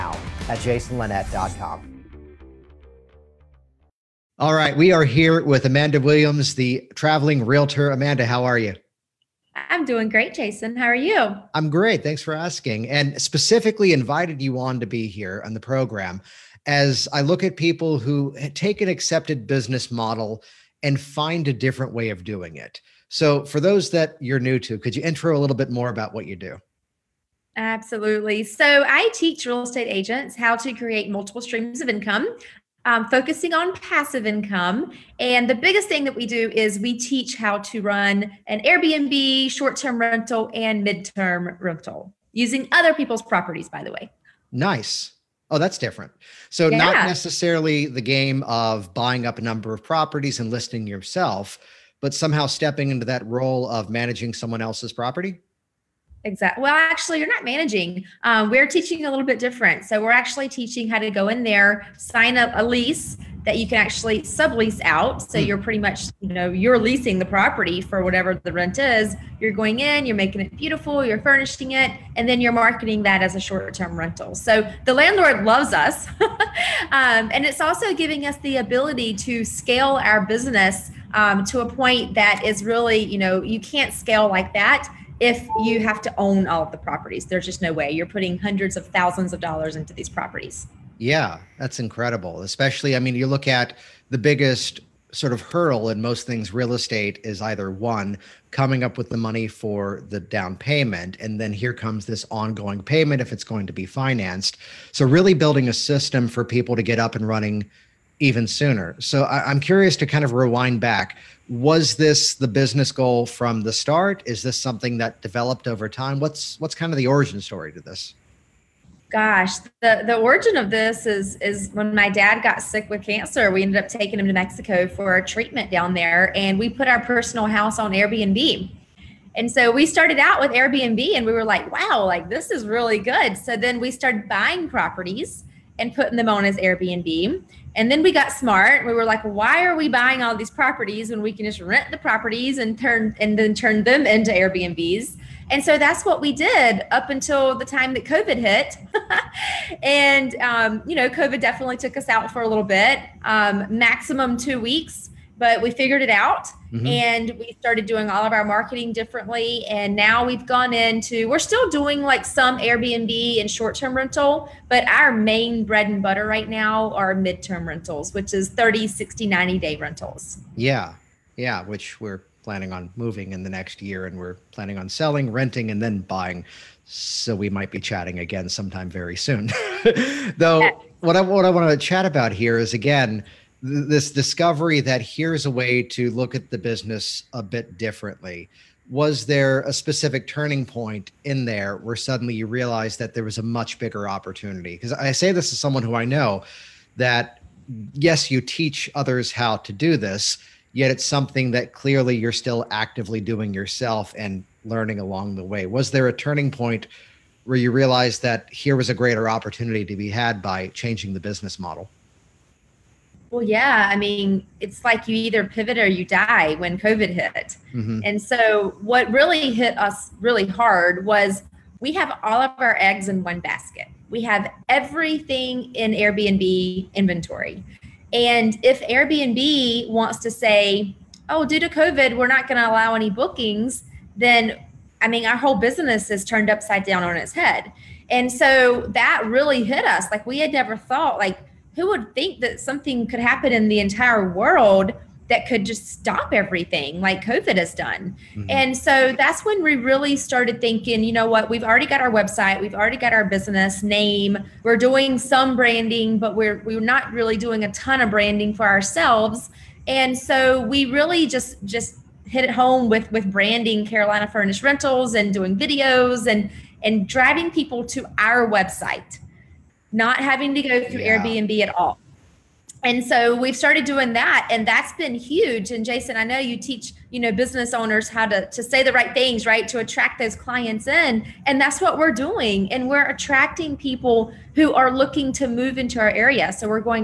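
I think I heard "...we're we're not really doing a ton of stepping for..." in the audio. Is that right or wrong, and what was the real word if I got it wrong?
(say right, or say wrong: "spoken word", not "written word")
wrong: "branding", not "stepping".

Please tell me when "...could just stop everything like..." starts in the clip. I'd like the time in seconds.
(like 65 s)
245 s.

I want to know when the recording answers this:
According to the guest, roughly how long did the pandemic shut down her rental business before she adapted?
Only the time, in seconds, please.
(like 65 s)
154 s.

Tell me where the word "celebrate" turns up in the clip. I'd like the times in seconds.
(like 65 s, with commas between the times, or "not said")
not said.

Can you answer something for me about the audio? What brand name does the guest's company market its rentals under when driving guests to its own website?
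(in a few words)
Carolina Furnished Rentals.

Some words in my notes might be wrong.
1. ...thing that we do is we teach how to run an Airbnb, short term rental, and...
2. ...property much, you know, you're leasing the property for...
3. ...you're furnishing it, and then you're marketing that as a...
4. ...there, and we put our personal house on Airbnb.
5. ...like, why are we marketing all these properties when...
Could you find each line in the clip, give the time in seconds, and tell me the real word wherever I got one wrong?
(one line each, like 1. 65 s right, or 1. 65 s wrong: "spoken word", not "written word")
1. 35 s right
2. 65 s wrong: "pretty", not "property"
3. 71 s right
4. 125 s right
5. 139 s wrong: "buying", not "marketing".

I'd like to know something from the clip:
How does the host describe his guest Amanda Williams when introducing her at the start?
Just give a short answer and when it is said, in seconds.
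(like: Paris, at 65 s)
the traveling realtor, at 6 s.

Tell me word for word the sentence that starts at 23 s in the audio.
So, for those that you're new to, could you intro a little bit more about what you do?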